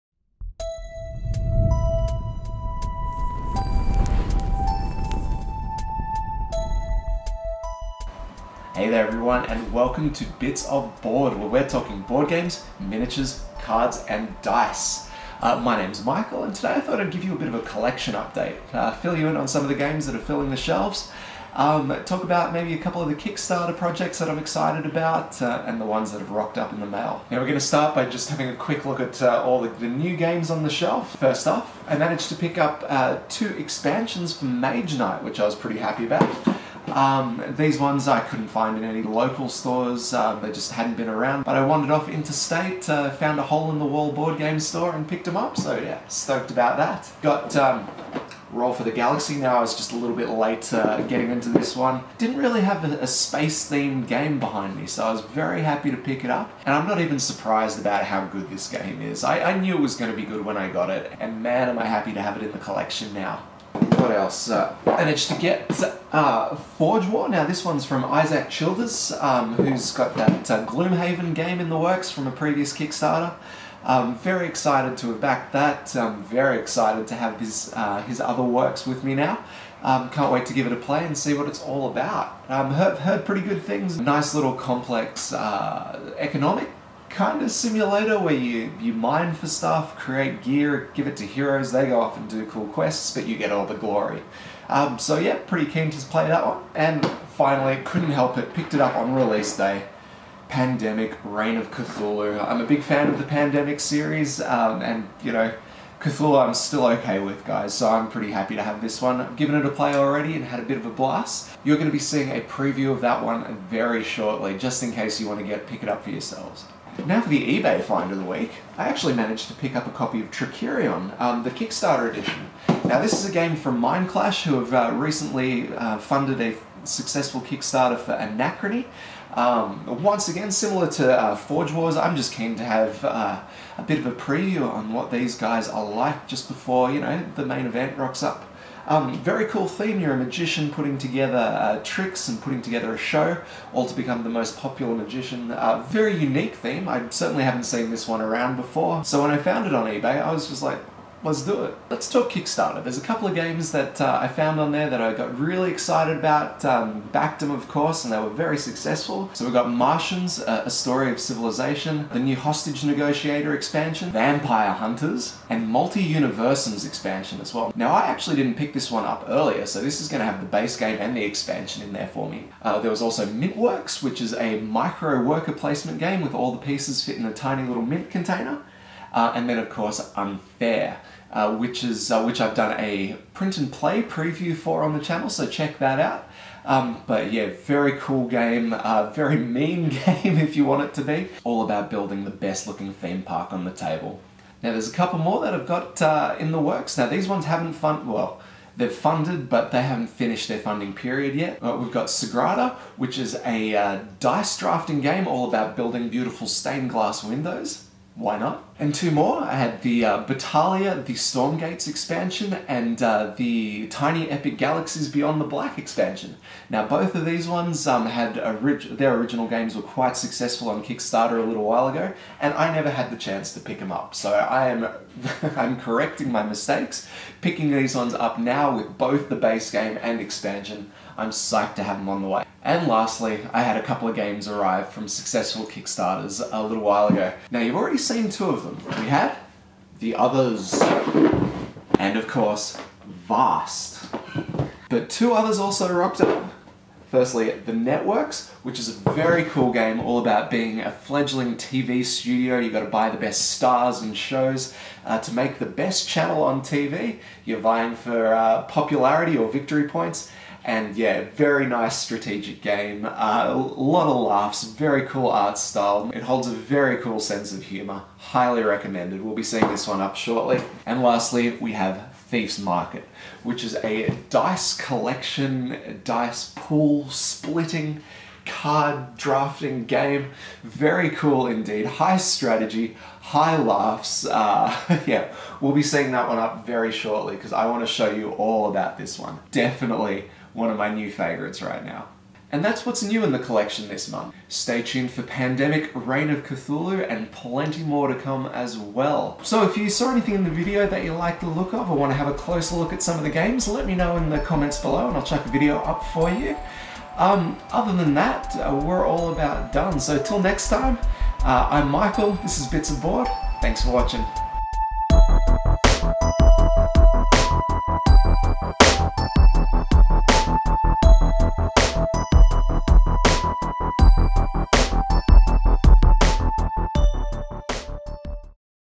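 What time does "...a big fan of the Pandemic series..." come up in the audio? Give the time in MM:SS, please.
01:42.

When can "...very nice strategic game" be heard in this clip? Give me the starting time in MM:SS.
04:21.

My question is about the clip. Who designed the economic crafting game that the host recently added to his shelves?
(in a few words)
Isaac Childres.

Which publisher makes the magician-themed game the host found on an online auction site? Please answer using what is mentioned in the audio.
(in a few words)
Mindclash.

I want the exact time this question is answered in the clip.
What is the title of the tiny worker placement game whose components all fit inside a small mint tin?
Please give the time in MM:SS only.
02:53.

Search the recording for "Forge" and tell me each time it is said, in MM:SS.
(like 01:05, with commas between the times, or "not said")
01:06, 02:11.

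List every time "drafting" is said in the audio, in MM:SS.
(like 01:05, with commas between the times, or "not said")
03:24, 04:39.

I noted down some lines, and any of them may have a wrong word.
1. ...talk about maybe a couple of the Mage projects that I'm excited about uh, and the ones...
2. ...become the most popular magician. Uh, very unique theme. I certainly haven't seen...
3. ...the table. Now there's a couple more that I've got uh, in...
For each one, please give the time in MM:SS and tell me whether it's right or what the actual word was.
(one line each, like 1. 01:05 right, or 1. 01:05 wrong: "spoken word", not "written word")
1. 00:22 wrong: "Kickstarter", not "Mage"
2. 02:23 right
3. 03:13 right.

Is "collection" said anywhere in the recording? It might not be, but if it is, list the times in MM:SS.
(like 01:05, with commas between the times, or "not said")
00:17, 01:02, 04:34, 04:53.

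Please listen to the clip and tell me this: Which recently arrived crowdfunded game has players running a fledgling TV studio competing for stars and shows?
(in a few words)
The Networks.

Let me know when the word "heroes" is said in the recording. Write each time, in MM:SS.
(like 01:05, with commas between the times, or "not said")
01:31.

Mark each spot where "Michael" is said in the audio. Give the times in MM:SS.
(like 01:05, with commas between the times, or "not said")
00:16, 05:11.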